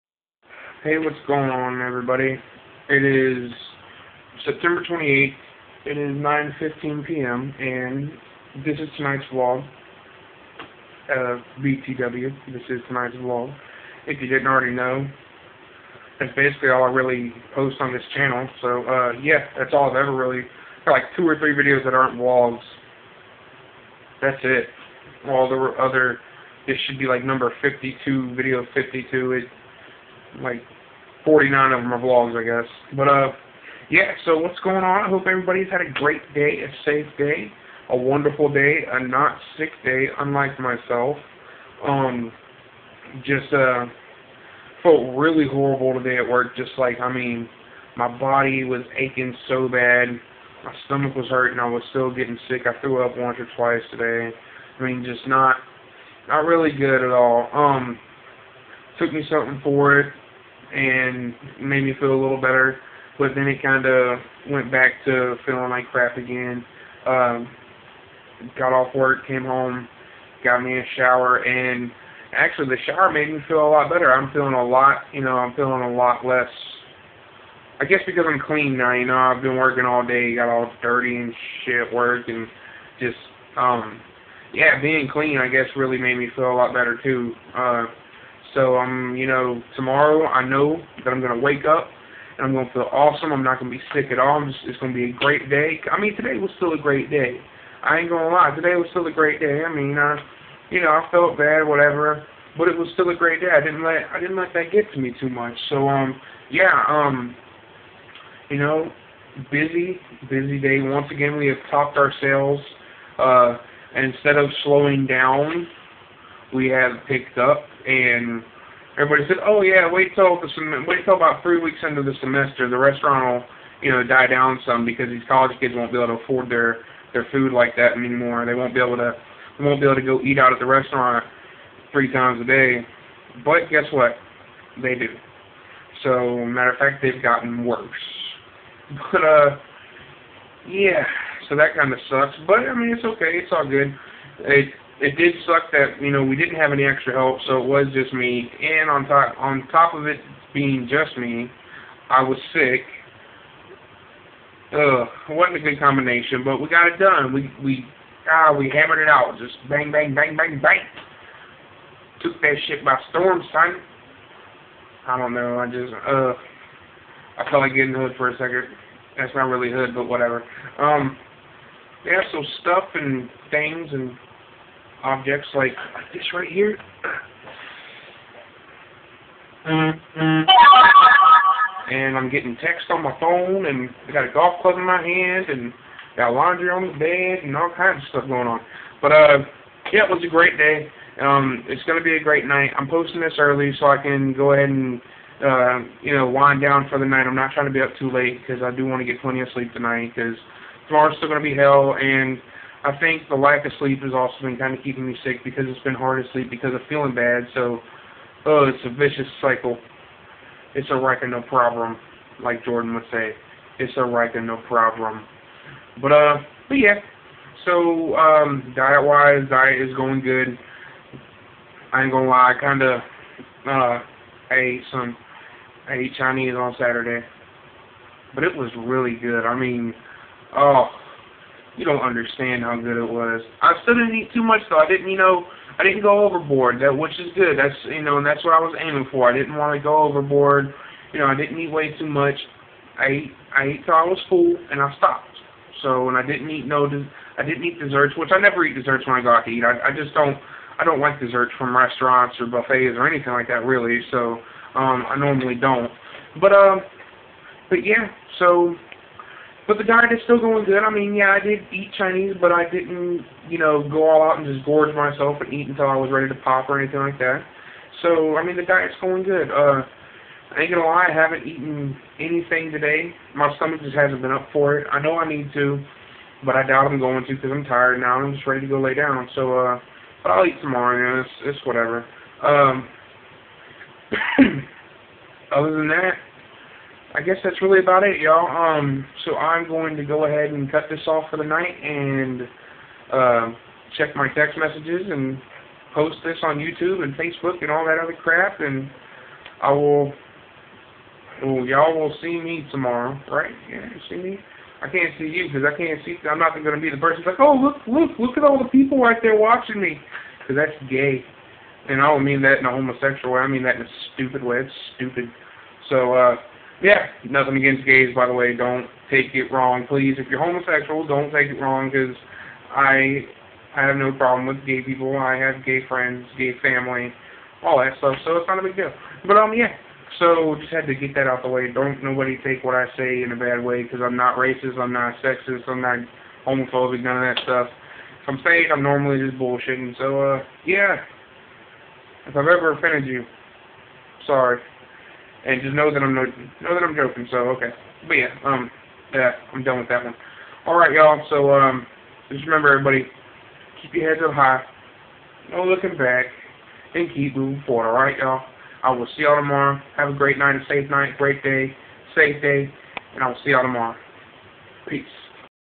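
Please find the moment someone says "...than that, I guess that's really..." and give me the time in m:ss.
4:45.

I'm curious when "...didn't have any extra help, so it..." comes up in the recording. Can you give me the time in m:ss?
2:26.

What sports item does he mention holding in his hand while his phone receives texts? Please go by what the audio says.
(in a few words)
golf club.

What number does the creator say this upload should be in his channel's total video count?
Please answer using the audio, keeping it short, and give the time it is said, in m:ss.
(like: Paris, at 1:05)
52, at 0:28.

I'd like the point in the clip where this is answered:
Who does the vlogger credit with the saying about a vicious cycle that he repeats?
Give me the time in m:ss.
3:32.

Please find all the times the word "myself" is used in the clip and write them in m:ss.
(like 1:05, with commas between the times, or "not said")
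0:40, 4:24.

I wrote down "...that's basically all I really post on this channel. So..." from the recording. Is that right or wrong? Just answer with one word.
right.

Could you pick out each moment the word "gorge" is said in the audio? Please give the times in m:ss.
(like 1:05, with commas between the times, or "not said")
4:24.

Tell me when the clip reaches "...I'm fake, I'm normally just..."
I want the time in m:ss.
5:38.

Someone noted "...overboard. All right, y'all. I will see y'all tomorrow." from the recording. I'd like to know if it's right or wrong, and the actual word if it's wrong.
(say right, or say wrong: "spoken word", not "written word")
wrong: "forward", not "overboard".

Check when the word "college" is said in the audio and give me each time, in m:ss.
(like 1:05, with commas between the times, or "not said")
2:05.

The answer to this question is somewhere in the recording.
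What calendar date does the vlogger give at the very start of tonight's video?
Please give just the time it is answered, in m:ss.
0:04.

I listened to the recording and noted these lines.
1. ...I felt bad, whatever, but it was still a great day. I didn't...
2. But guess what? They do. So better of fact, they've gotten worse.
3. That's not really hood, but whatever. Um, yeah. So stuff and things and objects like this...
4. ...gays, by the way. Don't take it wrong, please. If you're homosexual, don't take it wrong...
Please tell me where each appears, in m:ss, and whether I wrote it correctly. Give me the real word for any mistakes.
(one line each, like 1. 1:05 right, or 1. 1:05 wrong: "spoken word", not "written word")
1. 1:40 right
2. 2:13 wrong: "matter", not "better"
3. 2:49 right
4. 5:17 right.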